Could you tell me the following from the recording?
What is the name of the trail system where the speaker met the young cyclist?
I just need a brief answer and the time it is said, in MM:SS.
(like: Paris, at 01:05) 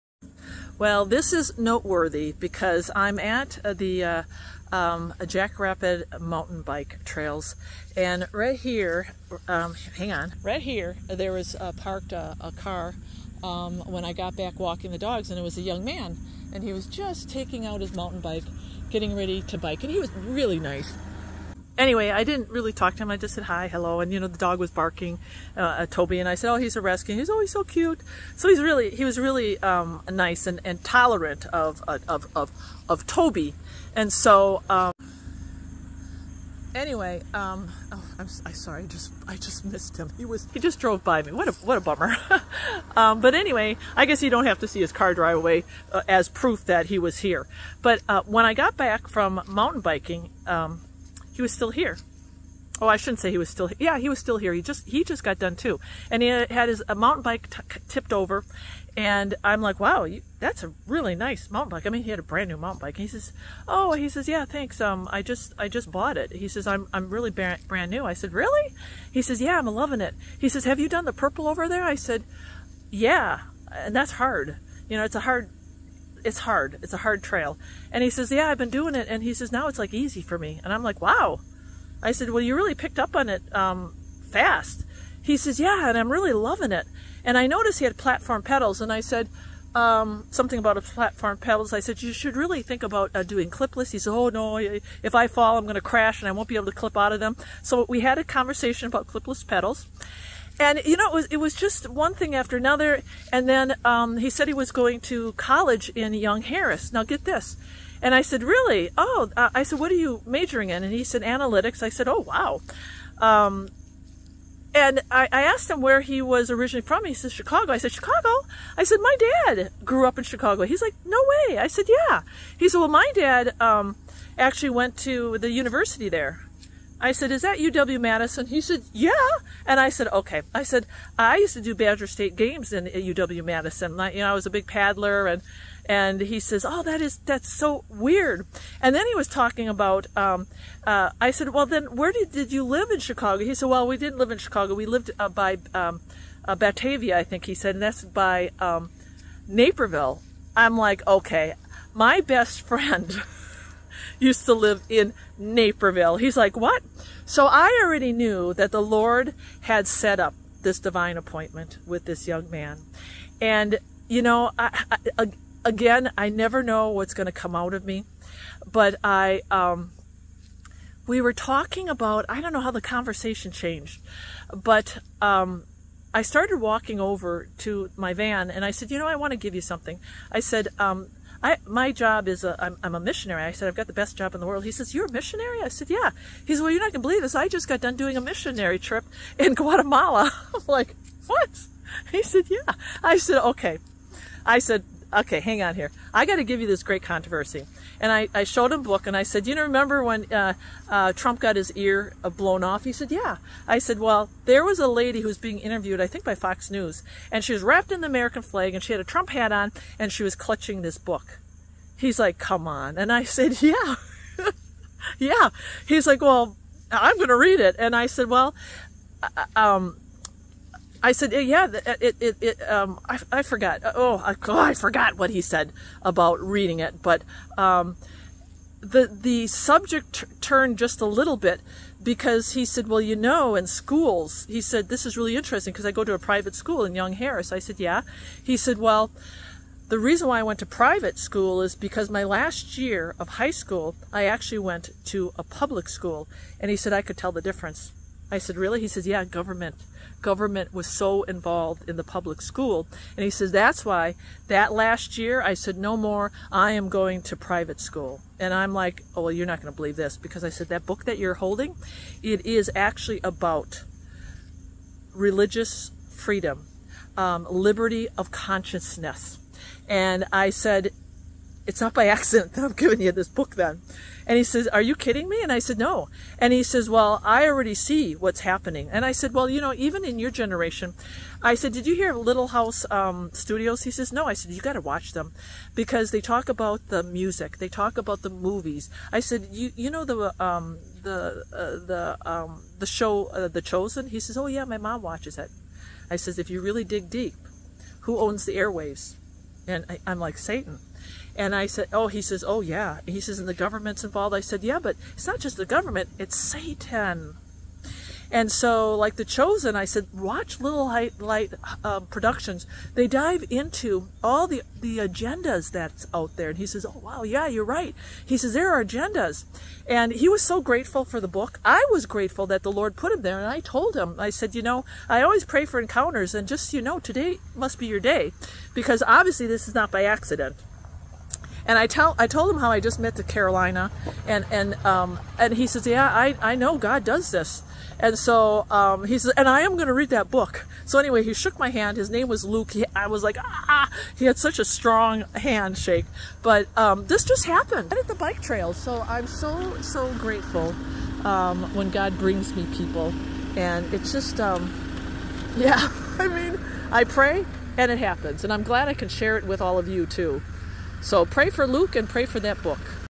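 Jackrabbit, at 00:05.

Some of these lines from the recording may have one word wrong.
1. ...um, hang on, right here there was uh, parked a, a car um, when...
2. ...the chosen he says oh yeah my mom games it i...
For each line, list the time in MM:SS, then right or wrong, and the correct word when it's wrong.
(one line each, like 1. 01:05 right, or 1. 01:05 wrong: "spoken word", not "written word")
1. 00:09 right
2. 04:53 wrong: "watches", not "games".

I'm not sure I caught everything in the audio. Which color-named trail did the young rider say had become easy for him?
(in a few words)
purple.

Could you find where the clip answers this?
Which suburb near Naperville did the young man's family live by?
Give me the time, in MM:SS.
02:26.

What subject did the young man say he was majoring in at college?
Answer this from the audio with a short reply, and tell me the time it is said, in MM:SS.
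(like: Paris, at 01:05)
analytics, at 01:51.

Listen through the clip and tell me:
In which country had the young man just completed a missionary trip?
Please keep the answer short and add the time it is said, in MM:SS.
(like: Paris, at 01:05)
Guatemala, at 03:09.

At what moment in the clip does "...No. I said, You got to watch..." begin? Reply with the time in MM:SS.
04:44.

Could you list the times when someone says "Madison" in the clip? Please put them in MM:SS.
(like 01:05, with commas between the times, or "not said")
02:07, 02:12.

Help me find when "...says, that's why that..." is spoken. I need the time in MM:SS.
04:13.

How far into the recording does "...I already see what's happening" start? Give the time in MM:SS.
04:37.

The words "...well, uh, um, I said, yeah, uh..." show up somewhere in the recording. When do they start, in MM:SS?
03:38.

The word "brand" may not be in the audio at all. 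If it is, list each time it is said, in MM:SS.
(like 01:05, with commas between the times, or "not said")
01:02, 01:07.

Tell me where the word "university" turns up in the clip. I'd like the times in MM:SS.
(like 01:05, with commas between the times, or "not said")
02:05.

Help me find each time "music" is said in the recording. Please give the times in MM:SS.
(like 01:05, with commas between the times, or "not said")
04:47.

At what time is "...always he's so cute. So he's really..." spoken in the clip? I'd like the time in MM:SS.
00:27.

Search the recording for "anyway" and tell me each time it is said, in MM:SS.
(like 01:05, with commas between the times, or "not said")
00:21, 00:36, 00:43, 05:40.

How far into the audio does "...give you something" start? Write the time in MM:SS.
02:59.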